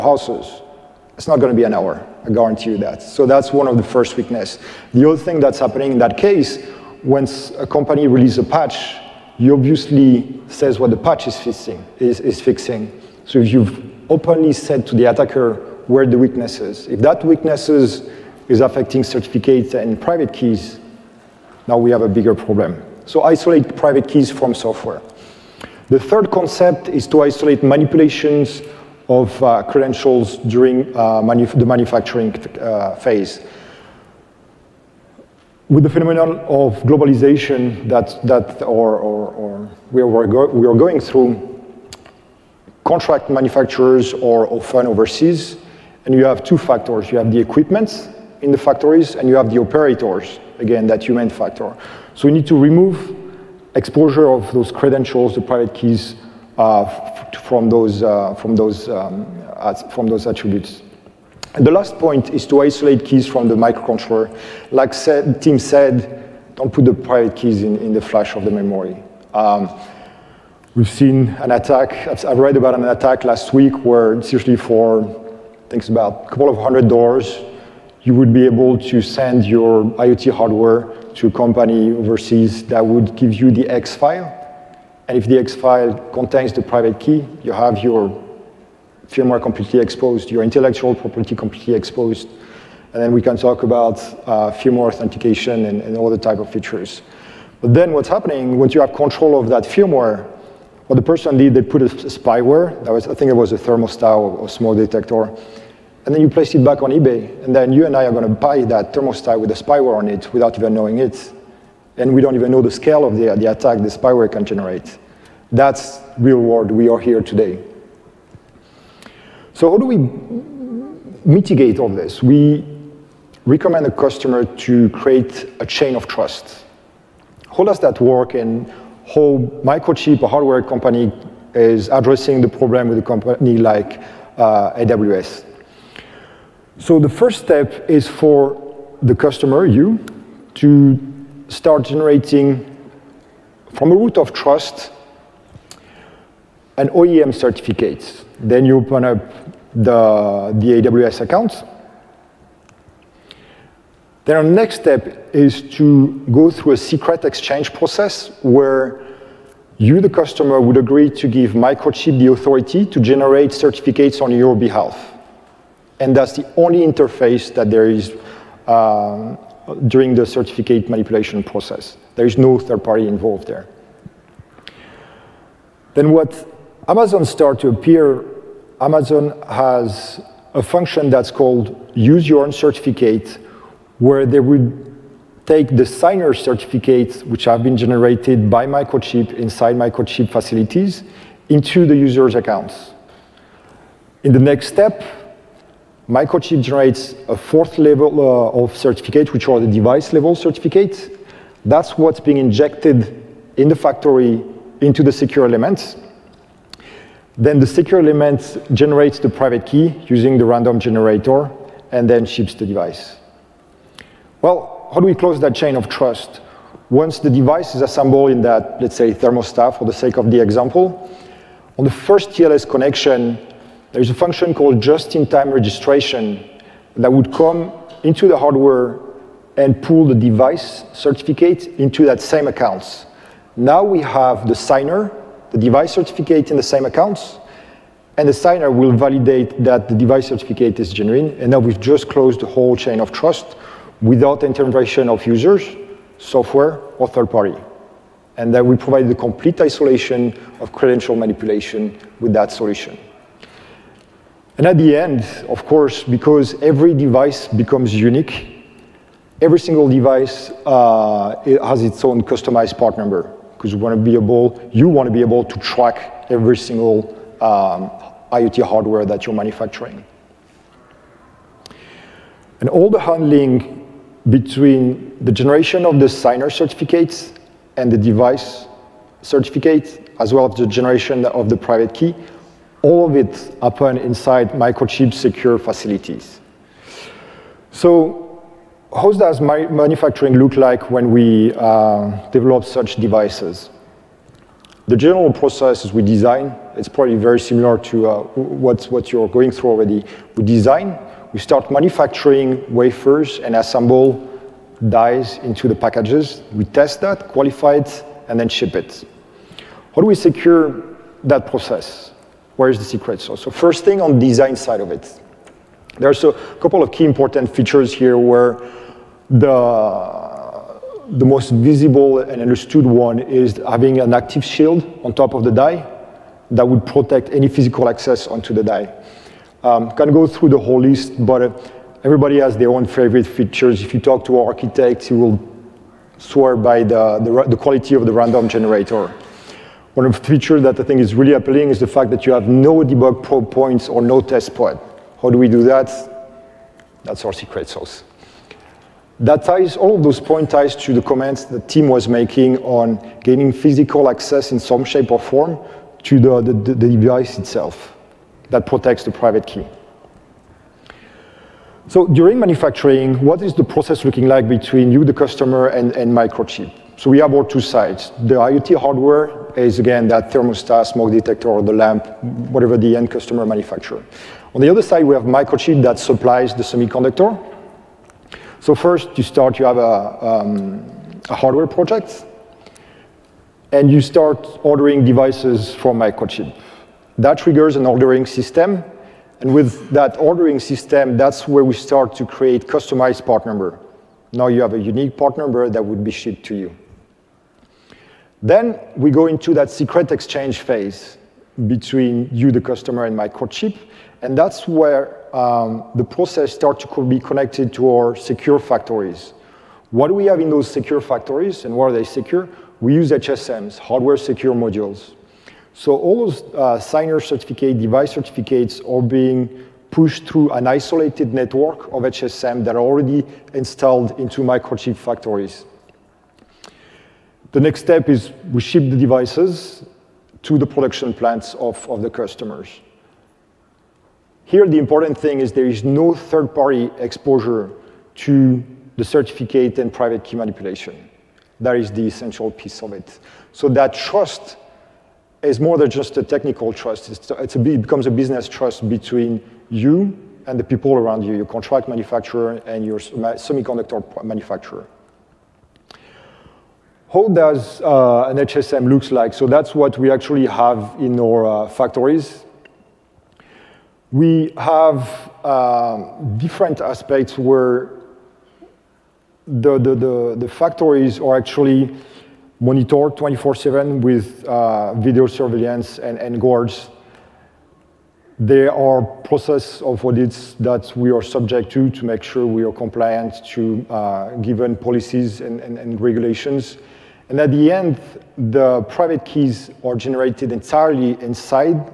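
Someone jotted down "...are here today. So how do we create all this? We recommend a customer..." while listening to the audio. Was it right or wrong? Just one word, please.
wrong.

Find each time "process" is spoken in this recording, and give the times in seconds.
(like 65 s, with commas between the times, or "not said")
157 s, 171 s, 295 s, 311 s, 363 s, 406 s, 479 s.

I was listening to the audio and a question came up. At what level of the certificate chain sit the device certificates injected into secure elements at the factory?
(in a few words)
Fourth.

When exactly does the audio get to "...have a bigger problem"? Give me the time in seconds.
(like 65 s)
21 s.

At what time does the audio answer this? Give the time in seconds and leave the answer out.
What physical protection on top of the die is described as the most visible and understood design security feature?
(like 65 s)
324 s.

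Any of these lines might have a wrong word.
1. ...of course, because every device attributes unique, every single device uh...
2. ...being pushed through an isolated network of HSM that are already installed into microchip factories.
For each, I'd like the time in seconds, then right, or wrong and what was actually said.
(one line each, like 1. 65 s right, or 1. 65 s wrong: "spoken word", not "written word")
1. 255 s wrong: "becomes", not "attributes"
2. 419 s right.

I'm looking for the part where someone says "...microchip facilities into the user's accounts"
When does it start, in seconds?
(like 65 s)
189 s.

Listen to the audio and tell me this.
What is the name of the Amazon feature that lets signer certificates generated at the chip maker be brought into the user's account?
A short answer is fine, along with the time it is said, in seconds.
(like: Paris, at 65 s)
Use your own certificate, at 181 s.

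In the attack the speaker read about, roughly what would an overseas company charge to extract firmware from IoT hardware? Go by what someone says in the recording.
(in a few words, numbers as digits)
A couple of hundred dollars.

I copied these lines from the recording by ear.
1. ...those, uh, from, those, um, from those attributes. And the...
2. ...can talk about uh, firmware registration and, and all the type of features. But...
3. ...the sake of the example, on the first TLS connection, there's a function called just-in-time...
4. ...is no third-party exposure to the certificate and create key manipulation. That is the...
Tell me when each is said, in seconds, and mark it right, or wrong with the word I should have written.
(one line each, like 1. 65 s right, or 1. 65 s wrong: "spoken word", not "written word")
1. 57 s right
2. 93 s wrong: "authentication", not "registration"
3. 219 s right
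4. 435 s wrong: "private", not "create".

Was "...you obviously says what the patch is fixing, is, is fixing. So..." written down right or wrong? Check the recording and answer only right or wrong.
right.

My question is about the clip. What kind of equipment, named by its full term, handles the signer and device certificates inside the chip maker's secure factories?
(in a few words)
Hardware secure modules.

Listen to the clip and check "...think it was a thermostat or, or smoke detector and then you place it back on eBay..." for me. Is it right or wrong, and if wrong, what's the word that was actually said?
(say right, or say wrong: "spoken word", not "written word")
right.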